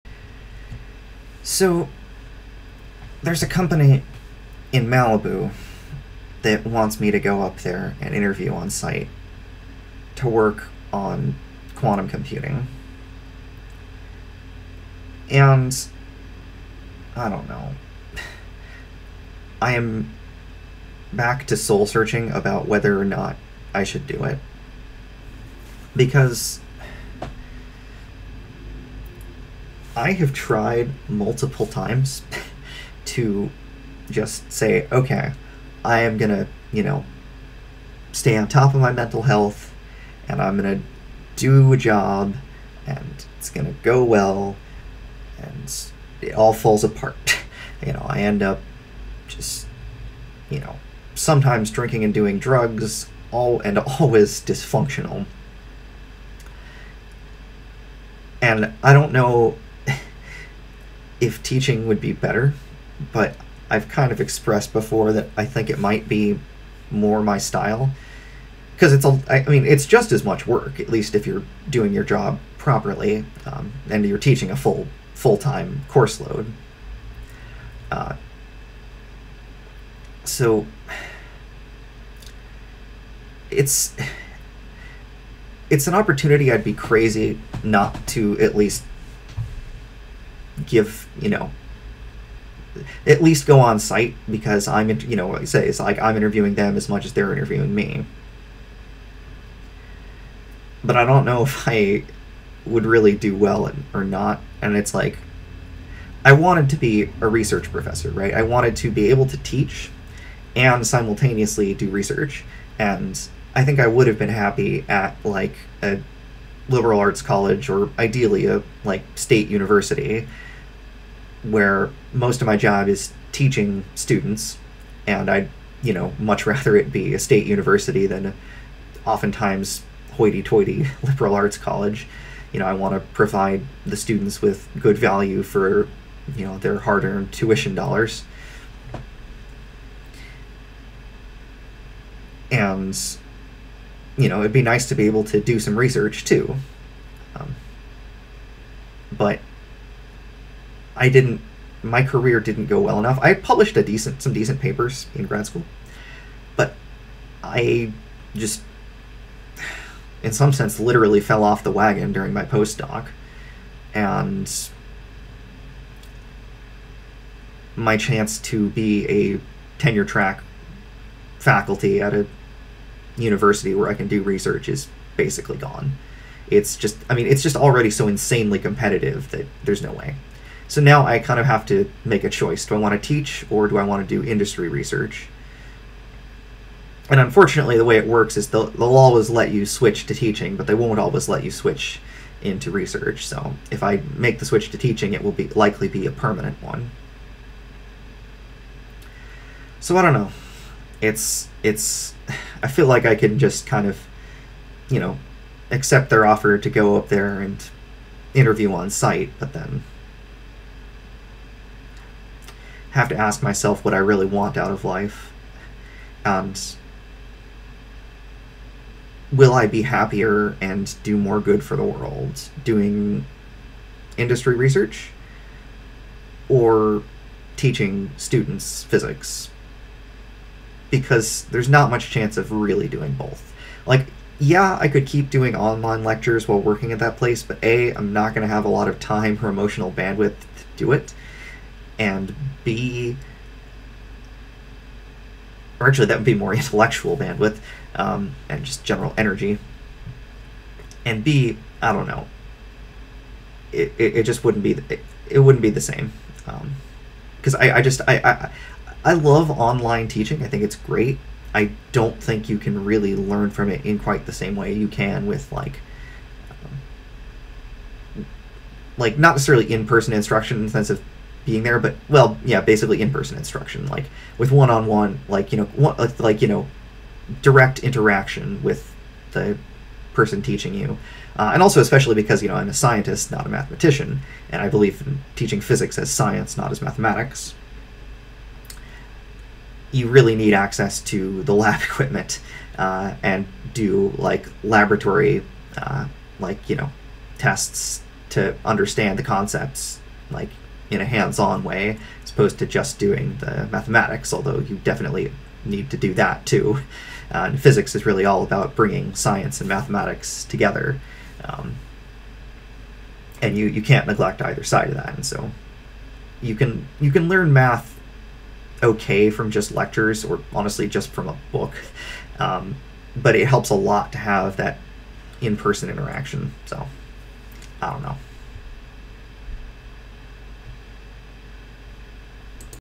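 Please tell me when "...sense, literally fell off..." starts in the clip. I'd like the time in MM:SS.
02:40.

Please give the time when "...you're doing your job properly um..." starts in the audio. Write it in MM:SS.
01:11.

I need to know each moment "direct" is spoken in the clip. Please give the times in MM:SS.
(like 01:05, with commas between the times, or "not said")
04:37.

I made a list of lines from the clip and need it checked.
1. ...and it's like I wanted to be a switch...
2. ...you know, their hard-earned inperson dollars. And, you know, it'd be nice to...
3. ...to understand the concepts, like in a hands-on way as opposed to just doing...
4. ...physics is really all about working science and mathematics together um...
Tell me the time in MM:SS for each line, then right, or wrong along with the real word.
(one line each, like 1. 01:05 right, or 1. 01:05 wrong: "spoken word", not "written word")
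1. 01:44 wrong: "research", not "switch"
2. 02:16 wrong: "tuition", not "inperson"
3. 04:58 right
4. 05:07 wrong: "bringing", not "working".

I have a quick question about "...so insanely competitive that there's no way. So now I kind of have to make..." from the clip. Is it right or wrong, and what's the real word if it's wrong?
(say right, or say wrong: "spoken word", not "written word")
right.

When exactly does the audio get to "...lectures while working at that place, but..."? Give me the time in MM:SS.
03:56.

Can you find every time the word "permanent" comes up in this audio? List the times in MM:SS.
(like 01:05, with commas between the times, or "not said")
03:16.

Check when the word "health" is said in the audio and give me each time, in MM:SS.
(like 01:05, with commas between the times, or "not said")
00:39.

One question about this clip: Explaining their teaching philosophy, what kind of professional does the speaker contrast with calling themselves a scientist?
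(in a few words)
Mathematician.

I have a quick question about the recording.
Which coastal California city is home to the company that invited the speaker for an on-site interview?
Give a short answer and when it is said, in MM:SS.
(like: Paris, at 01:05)
Malibu, at 00:04.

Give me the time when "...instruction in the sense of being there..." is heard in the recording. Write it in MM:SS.
04:30.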